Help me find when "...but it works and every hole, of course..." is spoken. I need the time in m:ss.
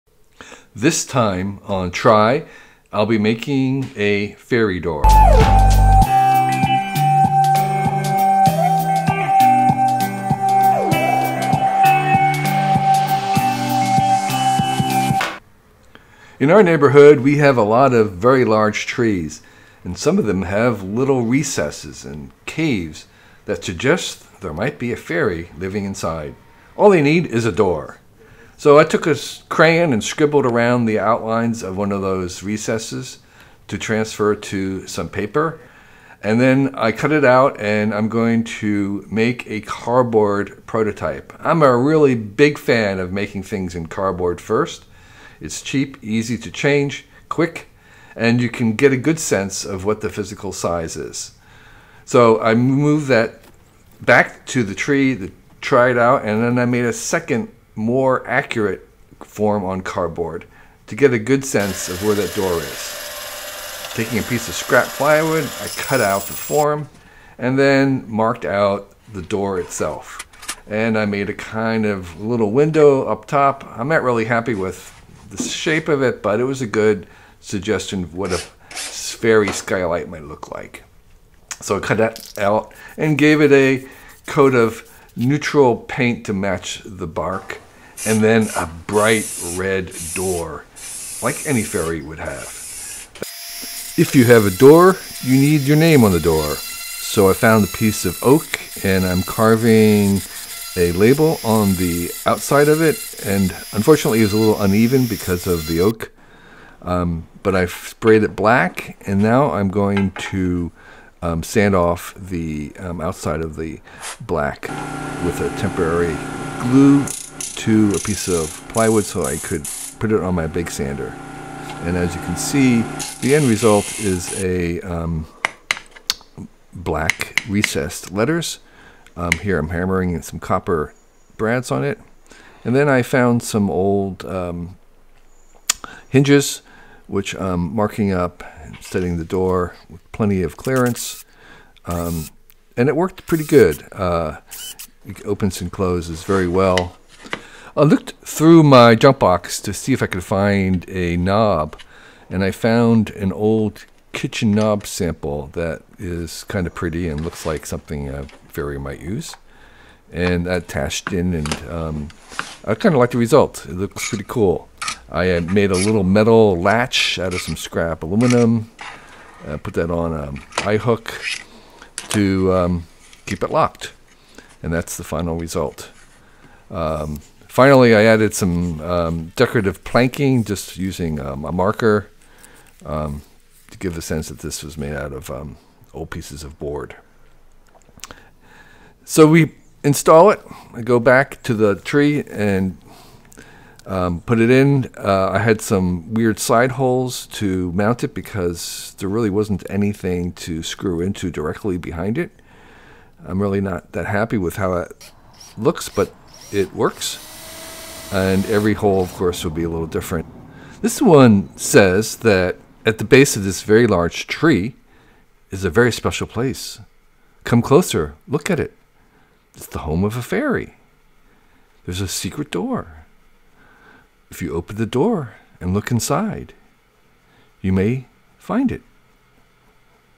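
3:25.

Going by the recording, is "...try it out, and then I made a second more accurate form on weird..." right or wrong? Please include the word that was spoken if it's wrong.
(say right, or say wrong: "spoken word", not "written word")
wrong: "cardboard", not "weird".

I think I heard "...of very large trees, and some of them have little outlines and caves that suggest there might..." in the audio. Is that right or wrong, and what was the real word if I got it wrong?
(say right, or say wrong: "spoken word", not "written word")
wrong: "recesses", not "outlines".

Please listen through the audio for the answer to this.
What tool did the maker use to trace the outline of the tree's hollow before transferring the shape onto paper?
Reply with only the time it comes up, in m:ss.
0:29.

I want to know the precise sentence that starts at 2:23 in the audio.
Uh, it opens and closes very well.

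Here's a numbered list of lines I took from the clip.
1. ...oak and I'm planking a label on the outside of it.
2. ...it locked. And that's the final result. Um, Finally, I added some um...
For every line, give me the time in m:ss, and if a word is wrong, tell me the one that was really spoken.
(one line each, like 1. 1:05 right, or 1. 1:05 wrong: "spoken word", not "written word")
1. 1:38 wrong: "carving", not "planking"
2. 2:53 right.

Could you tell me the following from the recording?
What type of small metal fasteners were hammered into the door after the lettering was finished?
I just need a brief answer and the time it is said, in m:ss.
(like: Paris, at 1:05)
copper brads, at 2:10.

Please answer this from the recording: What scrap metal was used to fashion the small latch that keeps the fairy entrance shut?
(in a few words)
aluminum.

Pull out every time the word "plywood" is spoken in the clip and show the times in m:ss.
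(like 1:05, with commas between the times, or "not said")
1:04, 1:58.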